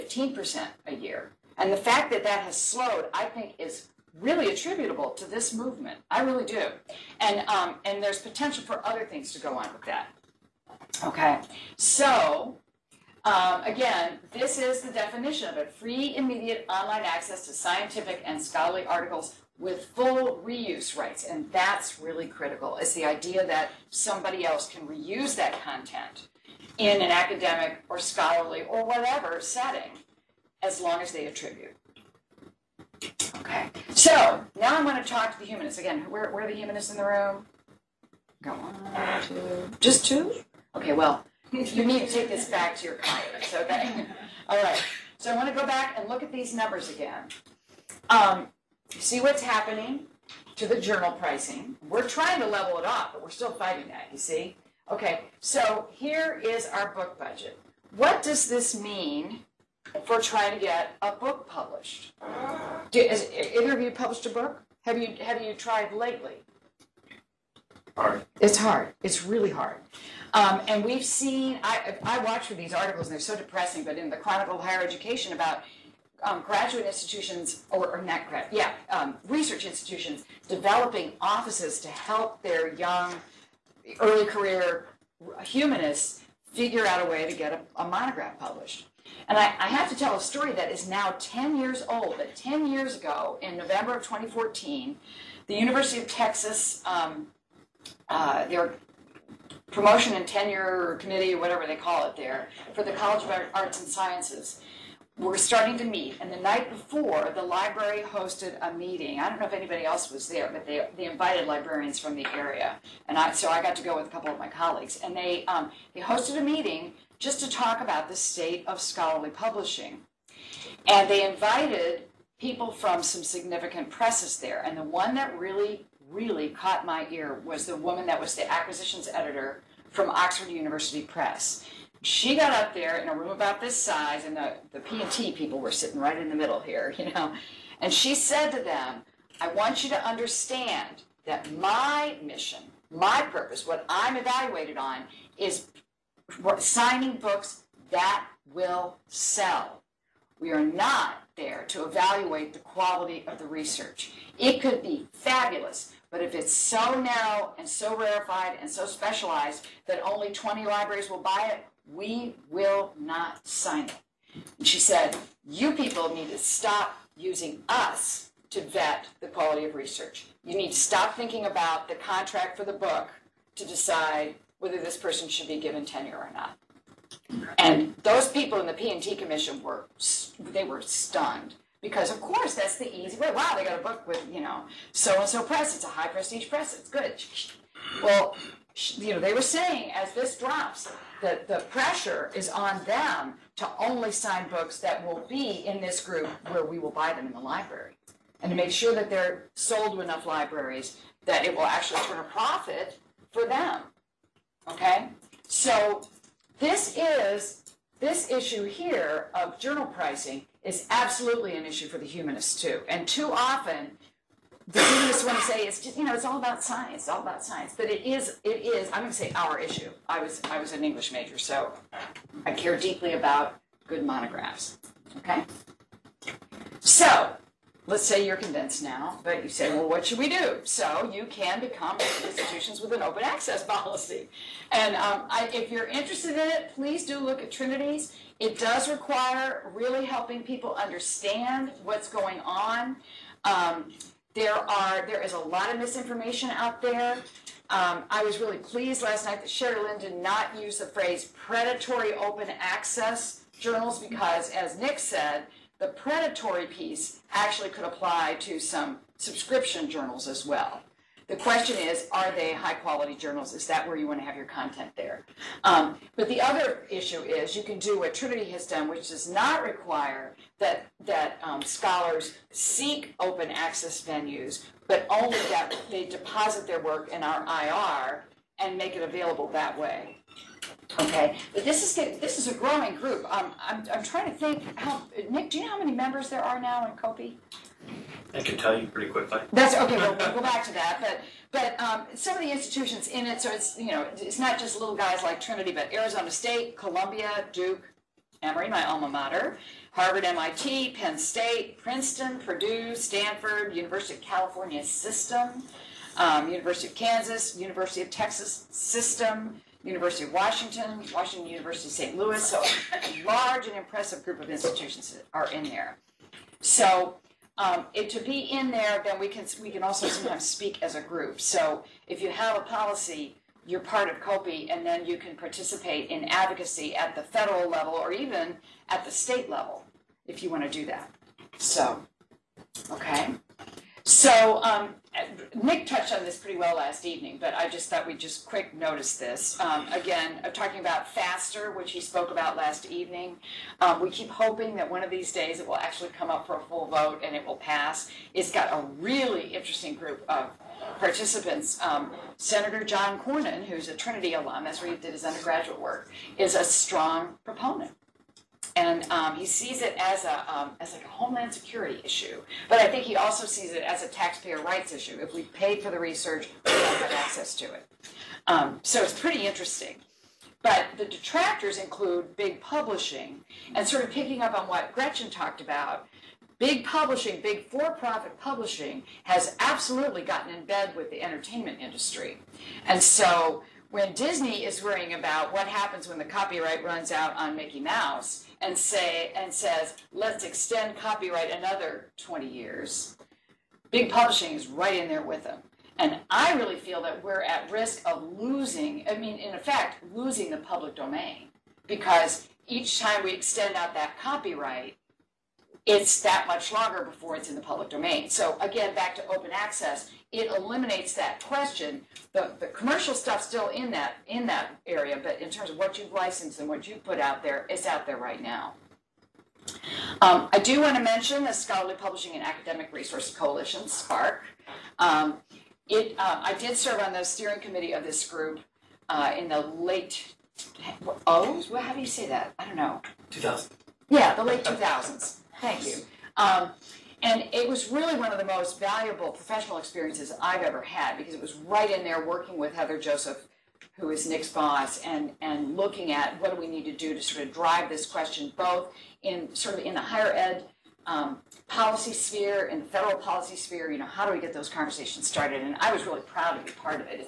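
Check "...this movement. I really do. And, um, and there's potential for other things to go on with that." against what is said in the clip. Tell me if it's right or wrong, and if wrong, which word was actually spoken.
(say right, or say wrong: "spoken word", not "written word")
right.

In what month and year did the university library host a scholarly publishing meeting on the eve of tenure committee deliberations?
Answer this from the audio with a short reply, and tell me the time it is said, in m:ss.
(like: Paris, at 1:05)
November 2014, at 1:33.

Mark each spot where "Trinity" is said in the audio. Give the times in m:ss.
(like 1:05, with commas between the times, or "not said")
3:57, 4:28, 4:55, 5:53.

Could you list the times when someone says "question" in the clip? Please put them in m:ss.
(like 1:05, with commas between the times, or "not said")
4:21, 6:51, 7:28.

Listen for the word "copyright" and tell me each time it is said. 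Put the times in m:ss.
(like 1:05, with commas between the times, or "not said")
6:26, 6:30, 6:44.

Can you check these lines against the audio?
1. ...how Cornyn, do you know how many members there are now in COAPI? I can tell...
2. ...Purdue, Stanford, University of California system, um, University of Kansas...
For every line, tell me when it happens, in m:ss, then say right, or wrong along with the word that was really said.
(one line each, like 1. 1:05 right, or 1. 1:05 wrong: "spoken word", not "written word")
1. 4:44 wrong: "Nick", not "Cornyn"
2. 5:02 right.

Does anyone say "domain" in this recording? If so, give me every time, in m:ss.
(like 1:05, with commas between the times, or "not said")
6:40, 6:47.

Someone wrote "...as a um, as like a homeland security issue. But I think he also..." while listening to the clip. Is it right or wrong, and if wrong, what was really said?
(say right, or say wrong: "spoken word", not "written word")
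right.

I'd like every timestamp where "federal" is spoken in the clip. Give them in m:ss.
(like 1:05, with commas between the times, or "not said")
5:27, 7:32.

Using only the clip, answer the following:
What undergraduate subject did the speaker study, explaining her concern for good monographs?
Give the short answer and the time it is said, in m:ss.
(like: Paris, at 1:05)
English, at 3:40.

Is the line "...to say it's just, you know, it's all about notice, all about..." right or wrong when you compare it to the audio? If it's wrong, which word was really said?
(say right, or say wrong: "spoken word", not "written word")
wrong: "science", not "notice".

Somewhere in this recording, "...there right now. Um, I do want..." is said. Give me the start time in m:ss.
6:58.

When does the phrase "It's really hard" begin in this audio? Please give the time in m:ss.
1:09.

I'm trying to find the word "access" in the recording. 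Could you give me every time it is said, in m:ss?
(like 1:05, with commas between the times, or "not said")
0:17, 3:53, 4:12, 4:33, 6:07, 6:49.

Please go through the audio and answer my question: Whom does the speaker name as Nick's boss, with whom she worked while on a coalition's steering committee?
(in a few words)
Heather Joseph.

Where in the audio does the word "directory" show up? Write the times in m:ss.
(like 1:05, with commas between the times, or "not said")
not said.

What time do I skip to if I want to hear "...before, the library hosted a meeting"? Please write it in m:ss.
1:46.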